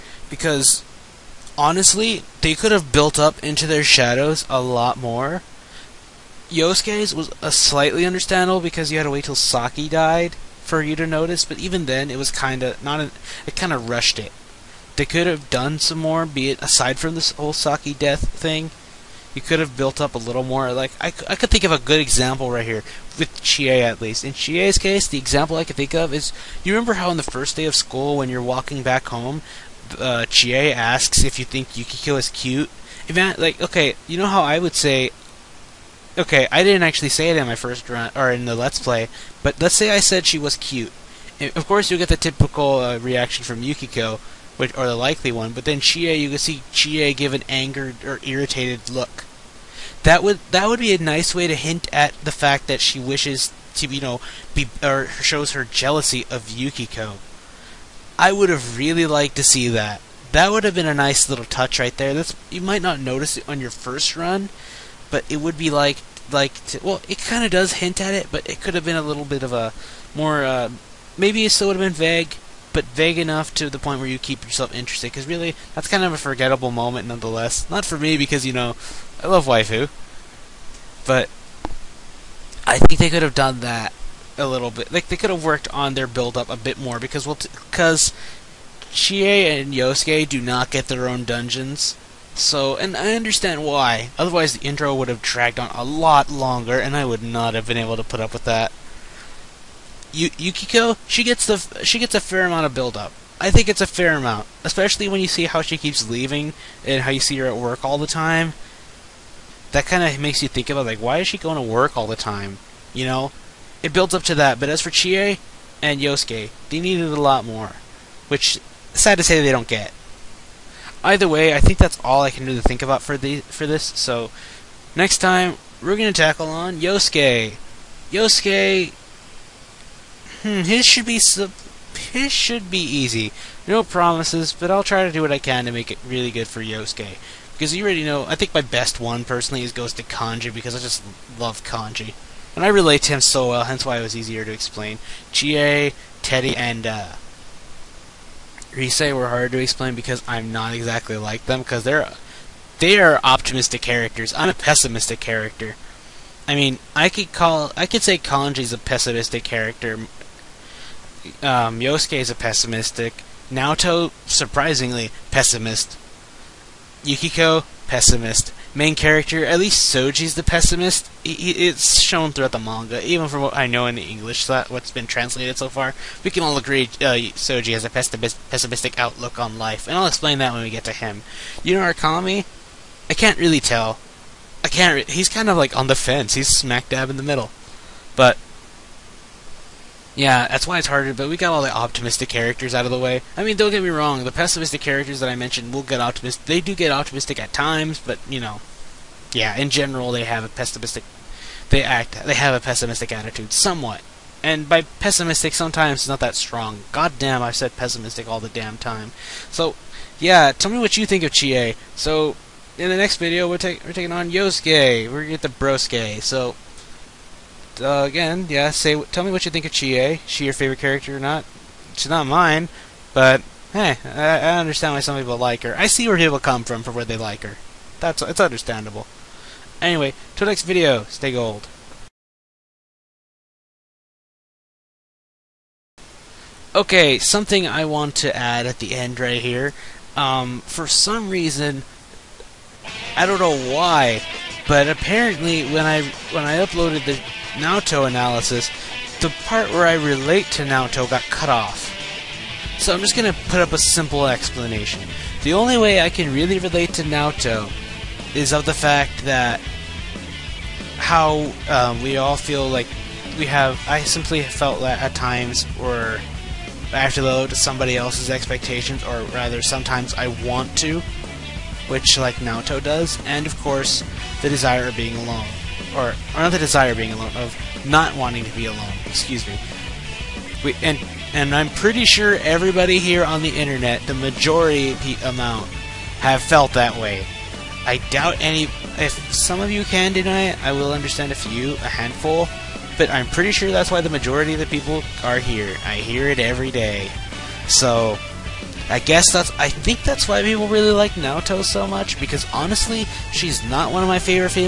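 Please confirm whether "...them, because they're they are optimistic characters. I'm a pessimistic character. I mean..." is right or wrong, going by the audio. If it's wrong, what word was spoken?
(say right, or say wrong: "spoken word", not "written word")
right.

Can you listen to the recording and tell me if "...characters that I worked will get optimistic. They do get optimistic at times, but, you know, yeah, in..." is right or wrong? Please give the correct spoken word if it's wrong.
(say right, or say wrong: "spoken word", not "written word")
wrong: "mentioned", not "worked".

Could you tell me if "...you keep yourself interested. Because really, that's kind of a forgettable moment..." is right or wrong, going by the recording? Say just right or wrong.
right.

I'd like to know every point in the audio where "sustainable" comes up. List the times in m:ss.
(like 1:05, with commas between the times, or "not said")
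not said.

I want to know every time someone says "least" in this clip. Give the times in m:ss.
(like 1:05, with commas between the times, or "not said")
0:23, 2:49.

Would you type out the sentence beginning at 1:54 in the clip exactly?
But as for Chie and Yosuke, they needed a lot more, which sad to say they don't get.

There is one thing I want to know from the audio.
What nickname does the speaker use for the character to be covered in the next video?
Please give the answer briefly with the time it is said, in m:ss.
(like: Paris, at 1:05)
Brosuke, at 3:35.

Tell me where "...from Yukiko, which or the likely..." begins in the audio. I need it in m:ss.
0:43.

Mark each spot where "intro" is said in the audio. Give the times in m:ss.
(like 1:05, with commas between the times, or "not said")
1:34.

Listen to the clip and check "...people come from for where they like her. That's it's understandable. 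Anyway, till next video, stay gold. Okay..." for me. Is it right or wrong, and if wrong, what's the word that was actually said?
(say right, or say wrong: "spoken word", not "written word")
right.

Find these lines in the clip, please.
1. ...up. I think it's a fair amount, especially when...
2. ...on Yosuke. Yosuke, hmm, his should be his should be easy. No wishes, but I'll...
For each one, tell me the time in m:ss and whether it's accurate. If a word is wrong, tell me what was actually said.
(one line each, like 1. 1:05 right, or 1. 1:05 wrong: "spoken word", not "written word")
1. 1:42 right
2. 2:06 wrong: "promises", not "wishes".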